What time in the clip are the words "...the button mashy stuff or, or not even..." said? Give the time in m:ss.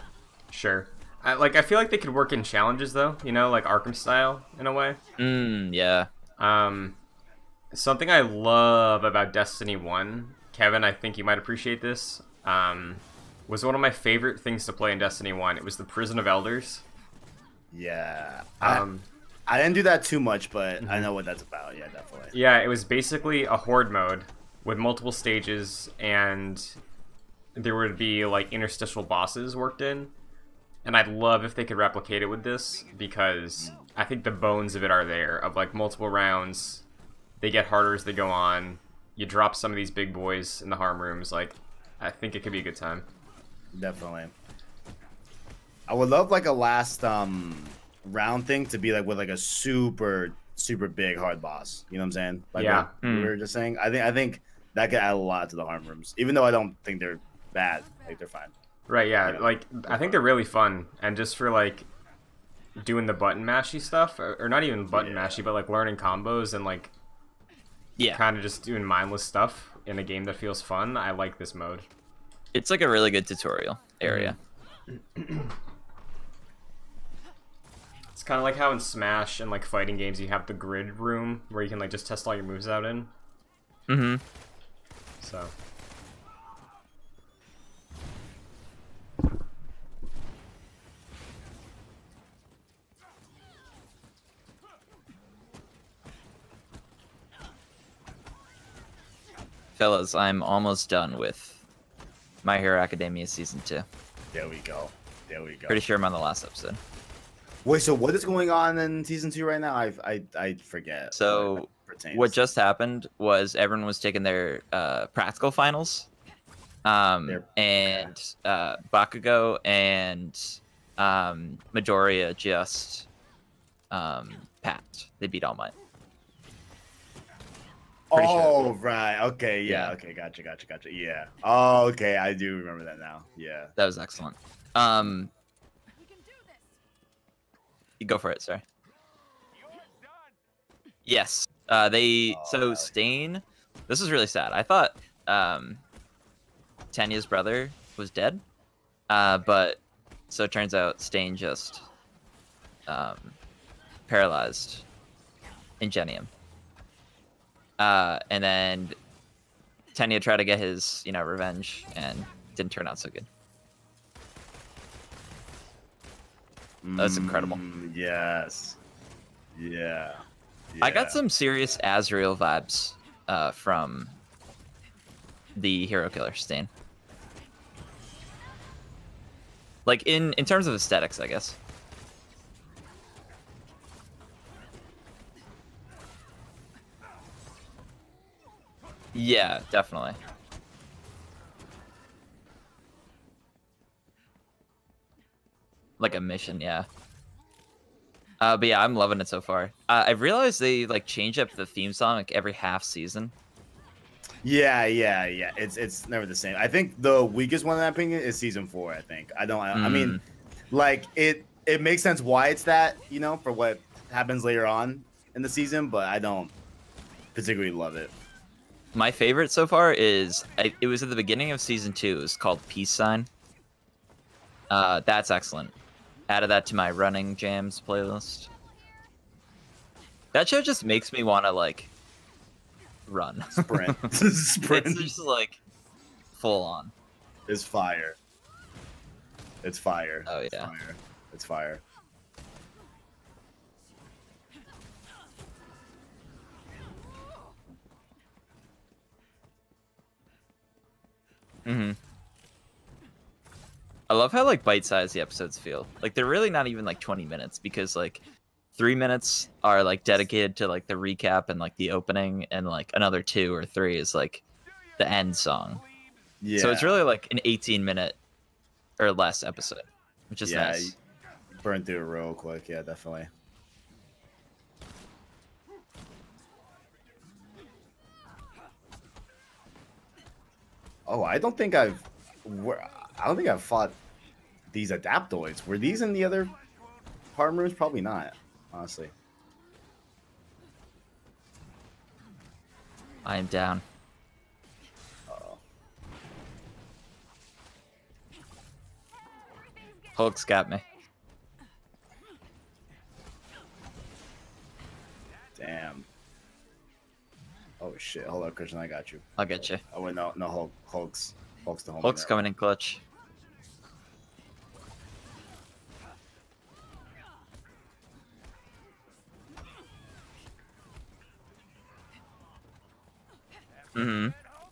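1:03.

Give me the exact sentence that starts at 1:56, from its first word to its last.
Um, and uh, Bakugo and um, Midoriya just um, passed.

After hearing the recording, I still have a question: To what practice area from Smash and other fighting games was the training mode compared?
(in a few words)
The grid room.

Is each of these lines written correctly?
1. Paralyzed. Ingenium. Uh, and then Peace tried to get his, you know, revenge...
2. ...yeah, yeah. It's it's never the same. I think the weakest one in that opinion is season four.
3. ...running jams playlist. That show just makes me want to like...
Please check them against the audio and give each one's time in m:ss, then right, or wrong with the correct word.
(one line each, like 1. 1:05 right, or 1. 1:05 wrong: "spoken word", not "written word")
1. 2:34 wrong: "Tenya", not "Peace"
2. 3:24 right
3. 3:46 right.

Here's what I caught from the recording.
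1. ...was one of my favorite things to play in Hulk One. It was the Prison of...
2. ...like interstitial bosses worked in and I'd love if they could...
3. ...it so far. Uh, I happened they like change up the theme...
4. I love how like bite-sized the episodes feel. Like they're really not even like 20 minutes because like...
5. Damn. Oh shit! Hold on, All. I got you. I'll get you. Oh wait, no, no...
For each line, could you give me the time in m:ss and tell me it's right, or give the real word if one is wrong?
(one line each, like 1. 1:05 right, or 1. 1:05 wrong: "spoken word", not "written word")
1. 0:13 wrong: "Destiny", not "Hulk"
2. 0:28 right
3. 3:19 wrong: "realized", not "happened"
4. 4:14 right
5. 5:05 wrong: "Christian", not "All".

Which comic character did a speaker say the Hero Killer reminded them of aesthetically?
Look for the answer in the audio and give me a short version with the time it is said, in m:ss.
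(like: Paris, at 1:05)
Azrael, at 2:51.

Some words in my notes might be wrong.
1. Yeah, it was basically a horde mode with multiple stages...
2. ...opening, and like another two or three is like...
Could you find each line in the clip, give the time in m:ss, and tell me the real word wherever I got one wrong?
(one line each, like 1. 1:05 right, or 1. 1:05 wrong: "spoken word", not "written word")
1. 0:22 right
2. 4:21 right.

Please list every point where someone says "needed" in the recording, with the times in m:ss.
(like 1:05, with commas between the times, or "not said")
not said.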